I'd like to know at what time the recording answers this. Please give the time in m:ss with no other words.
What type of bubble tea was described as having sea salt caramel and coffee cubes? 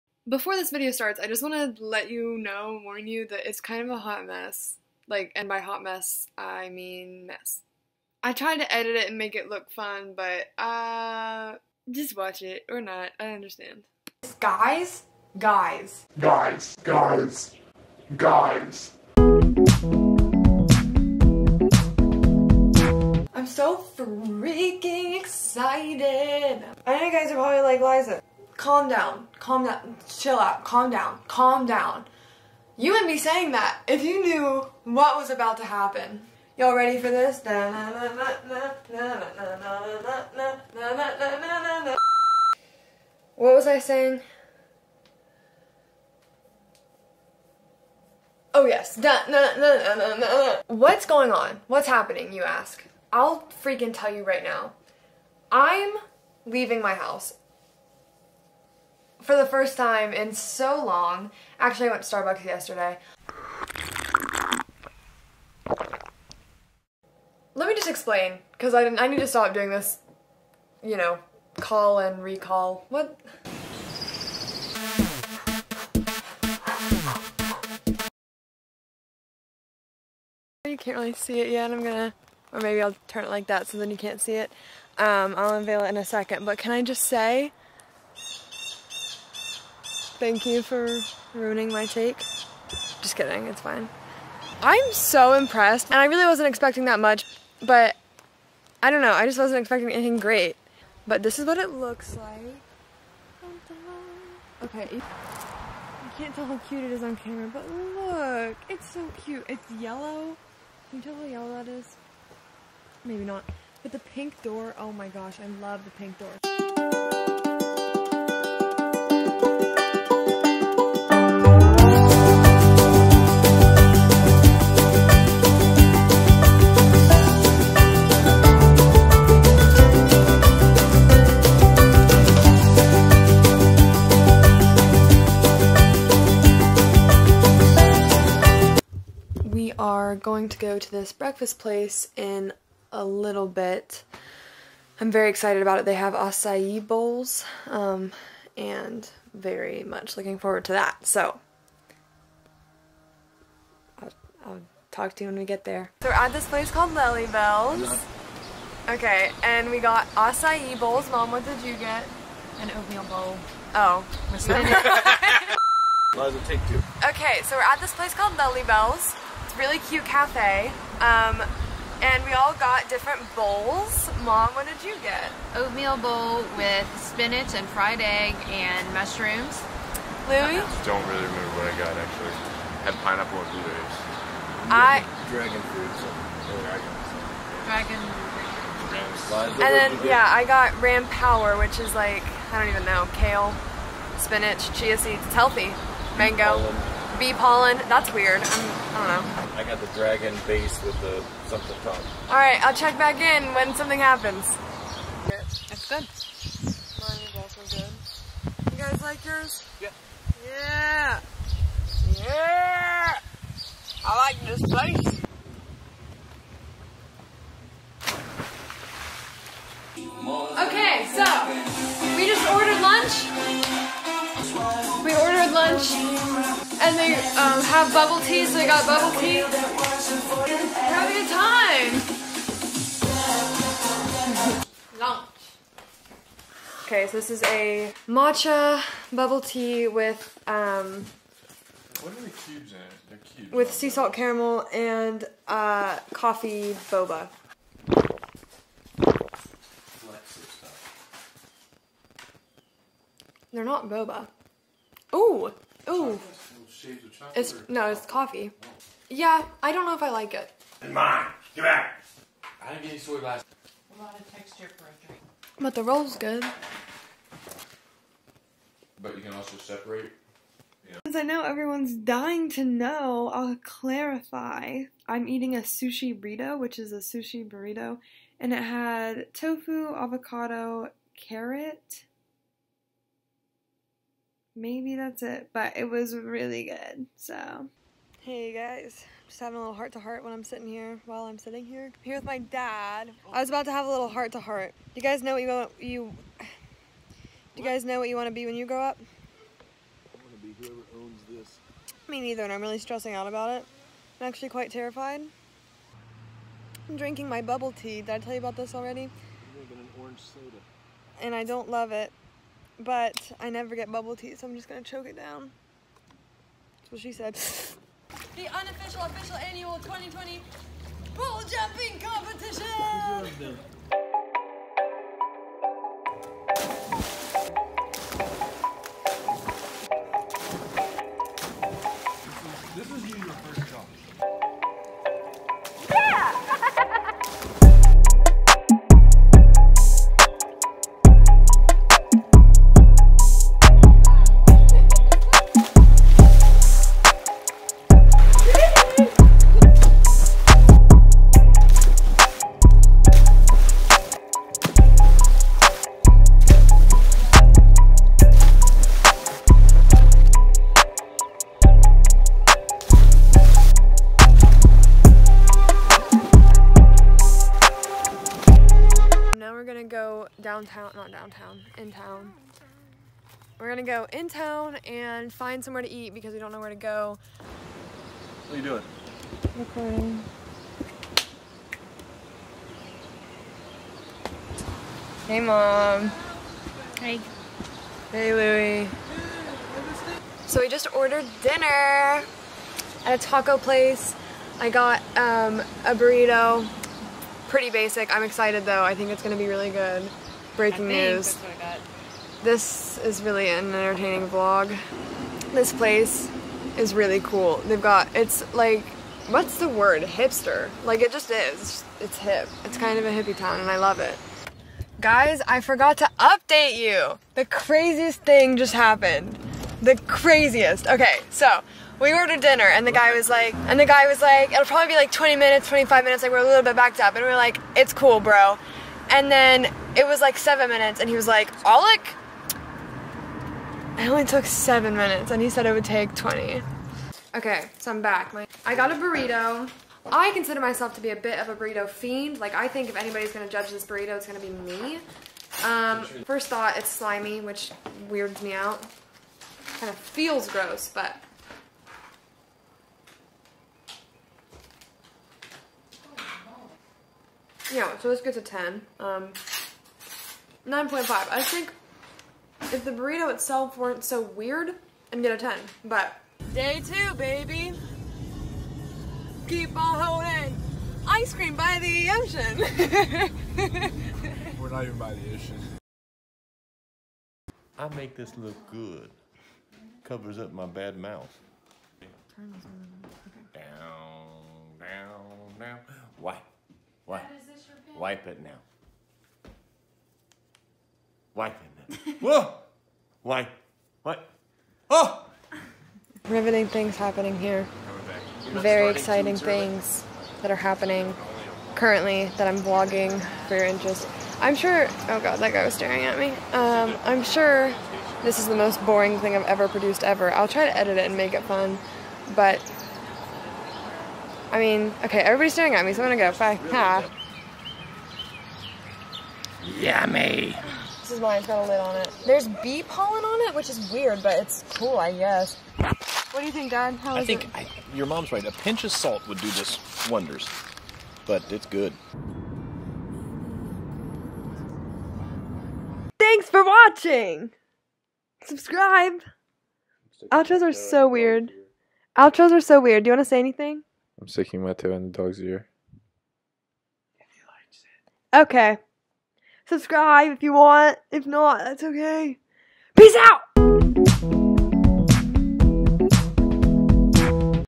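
3:58.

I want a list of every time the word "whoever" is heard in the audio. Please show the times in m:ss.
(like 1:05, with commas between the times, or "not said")
5:00.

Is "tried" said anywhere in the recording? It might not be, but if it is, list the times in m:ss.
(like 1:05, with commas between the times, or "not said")
0:08.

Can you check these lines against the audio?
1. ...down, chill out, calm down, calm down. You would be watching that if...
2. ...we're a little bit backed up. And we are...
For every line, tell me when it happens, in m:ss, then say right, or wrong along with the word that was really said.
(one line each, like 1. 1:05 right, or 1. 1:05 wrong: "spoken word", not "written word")
1. 0:29 wrong: "saying", not "watching"
2. 7:06 right.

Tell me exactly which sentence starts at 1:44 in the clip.
Okay, you can't tell how cute it is on camera, but look, it's so cute.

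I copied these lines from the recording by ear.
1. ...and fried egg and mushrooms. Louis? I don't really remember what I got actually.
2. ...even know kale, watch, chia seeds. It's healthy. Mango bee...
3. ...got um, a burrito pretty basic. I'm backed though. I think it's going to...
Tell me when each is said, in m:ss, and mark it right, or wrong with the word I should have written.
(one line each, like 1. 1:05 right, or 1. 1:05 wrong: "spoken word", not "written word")
1. 2:57 right
2. 3:12 wrong: "spinach", not "watch"
3. 6:34 wrong: "excited", not "backed".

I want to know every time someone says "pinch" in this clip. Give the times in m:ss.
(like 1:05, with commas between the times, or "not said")
8:48.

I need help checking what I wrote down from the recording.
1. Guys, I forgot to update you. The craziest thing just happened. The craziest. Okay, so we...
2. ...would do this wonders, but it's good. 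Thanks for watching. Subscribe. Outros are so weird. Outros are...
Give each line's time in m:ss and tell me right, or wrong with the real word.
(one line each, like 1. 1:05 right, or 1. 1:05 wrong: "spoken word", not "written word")
1. 6:55 right
2. 8:49 right.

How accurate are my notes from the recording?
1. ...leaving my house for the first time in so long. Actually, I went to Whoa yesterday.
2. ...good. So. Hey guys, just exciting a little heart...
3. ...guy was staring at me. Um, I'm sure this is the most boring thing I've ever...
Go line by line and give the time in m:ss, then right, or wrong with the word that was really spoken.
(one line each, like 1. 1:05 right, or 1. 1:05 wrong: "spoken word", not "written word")
1. 0:56 wrong: "Starbucks", not "Whoa"
2. 4:46 wrong: "having", not "exciting"
3. 8:25 right.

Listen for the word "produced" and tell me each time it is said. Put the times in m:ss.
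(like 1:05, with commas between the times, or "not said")
8:29.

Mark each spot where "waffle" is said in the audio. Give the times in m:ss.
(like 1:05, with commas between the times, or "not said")
not said.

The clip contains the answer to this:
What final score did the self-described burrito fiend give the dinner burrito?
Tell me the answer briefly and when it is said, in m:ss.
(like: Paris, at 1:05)
9.5, at 7:40.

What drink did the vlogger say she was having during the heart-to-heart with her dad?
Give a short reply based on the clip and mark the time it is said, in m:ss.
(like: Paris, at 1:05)
Orange soda, at 5:09.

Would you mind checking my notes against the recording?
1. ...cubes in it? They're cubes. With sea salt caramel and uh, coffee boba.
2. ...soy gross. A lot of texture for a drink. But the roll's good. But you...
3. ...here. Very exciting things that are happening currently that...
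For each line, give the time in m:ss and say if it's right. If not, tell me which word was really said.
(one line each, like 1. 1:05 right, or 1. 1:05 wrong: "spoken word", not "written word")
1. 4:02 right
2. 4:22 wrong: "glass", not "gross"
3. 8:17 right.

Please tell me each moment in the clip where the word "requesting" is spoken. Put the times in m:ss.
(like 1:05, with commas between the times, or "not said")
not said.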